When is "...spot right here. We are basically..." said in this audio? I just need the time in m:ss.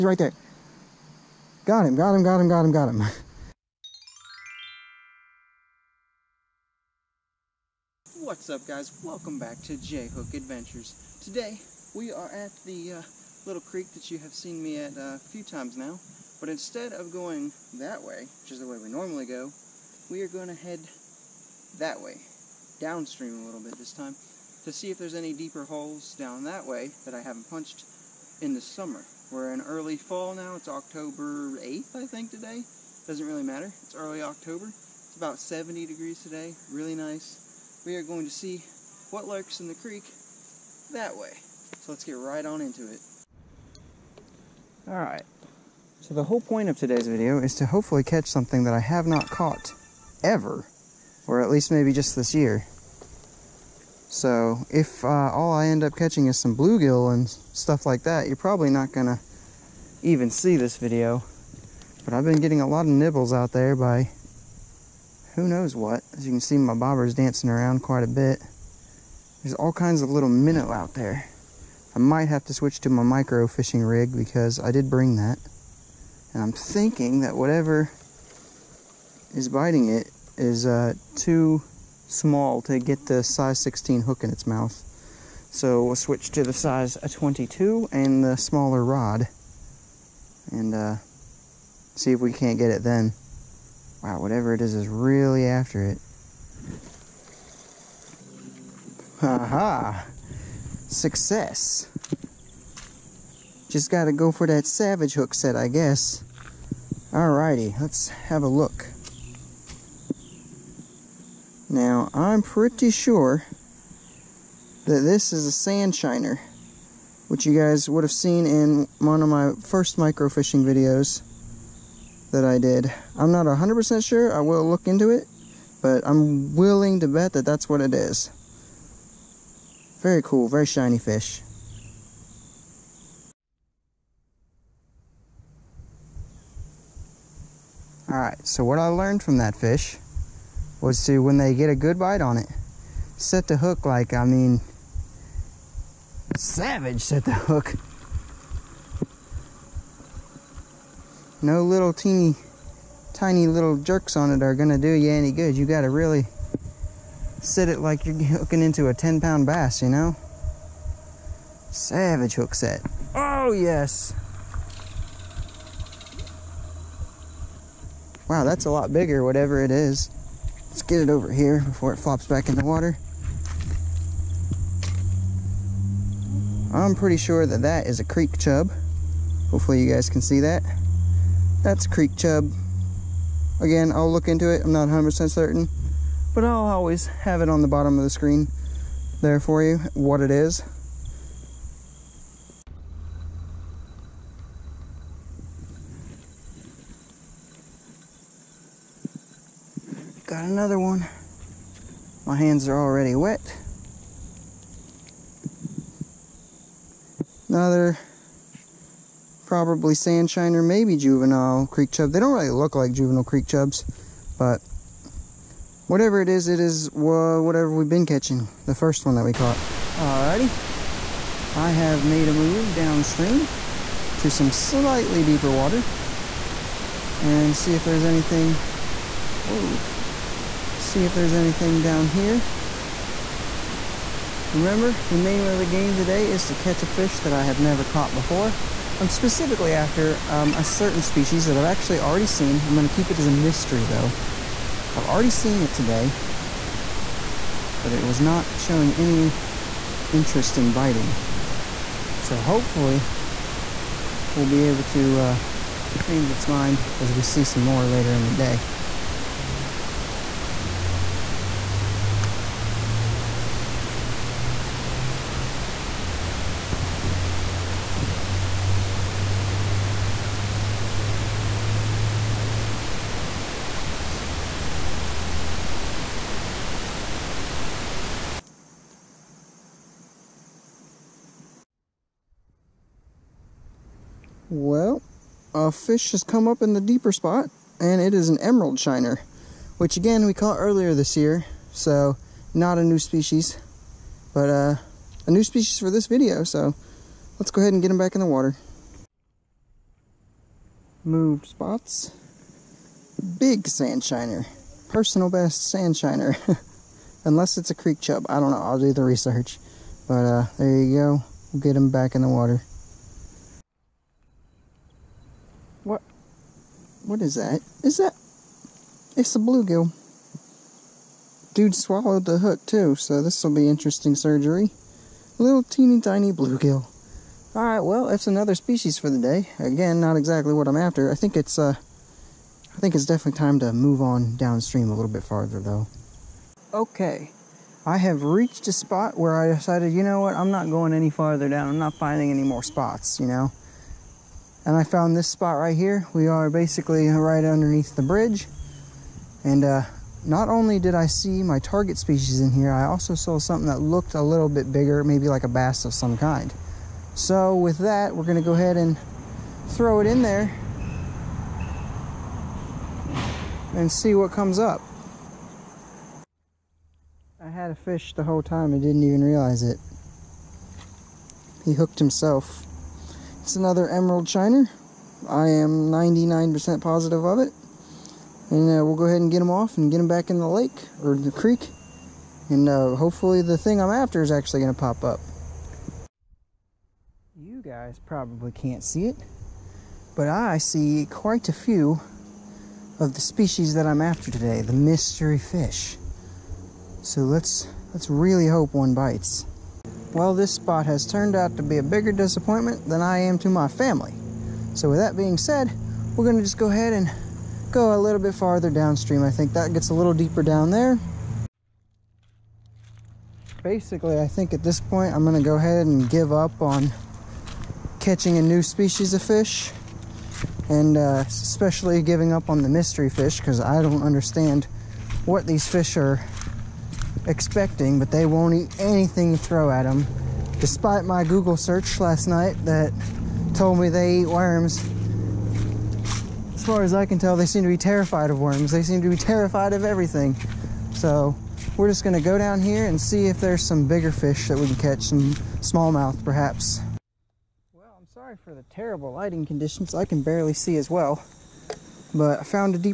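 5:45.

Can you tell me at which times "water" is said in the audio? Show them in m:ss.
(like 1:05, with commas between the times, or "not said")
2:52, 3:45, 4:58, 5:12.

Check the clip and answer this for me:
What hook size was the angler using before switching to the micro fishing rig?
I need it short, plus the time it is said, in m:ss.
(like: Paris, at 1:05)
16, at 1:23.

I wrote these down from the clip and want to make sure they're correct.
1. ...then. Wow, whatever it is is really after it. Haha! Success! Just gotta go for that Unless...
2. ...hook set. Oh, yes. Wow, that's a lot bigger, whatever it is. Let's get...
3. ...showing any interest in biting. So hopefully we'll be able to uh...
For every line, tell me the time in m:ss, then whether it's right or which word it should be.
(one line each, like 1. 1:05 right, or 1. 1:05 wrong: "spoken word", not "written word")
1. 1:32 wrong: "Savage", not "Unless"
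2. 2:42 right
3. 4:08 right.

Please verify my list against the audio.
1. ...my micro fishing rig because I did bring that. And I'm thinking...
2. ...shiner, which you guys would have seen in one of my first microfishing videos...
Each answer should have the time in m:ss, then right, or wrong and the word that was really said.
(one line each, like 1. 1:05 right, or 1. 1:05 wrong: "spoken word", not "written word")
1. 1:12 right
2. 1:55 right.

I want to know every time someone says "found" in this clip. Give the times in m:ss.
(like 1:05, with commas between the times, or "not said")
5:44, 7:32.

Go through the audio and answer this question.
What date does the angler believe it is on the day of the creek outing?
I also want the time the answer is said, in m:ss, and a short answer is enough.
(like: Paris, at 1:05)
October 8th, at 0:30.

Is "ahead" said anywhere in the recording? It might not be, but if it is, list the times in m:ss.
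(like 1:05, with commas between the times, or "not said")
4:57, 5:58, 6:19, 6:46, 6:55.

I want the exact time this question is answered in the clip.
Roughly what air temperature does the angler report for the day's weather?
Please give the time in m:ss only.
0:35.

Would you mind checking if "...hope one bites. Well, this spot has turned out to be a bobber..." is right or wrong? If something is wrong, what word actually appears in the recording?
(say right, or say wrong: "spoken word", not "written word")
wrong: "bigger", not "bobber".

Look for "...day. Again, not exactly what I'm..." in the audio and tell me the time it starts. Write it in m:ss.
5:29.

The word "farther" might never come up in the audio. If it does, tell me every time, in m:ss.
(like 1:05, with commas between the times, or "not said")
5:35, 5:41, 6:48.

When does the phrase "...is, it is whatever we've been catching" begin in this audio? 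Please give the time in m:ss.
3:36.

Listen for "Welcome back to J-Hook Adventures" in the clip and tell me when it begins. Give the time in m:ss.
0:09.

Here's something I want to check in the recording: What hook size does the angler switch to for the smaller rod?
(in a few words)
22.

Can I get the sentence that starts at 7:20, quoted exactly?
So we're just gonna go down here and see if there's some bigger fish that we can catch, some smallmouth perhaps.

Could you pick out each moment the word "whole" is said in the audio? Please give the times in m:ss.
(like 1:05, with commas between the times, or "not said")
0:46, 6:08.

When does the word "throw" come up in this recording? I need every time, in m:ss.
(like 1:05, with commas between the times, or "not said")
5:59, 7:09.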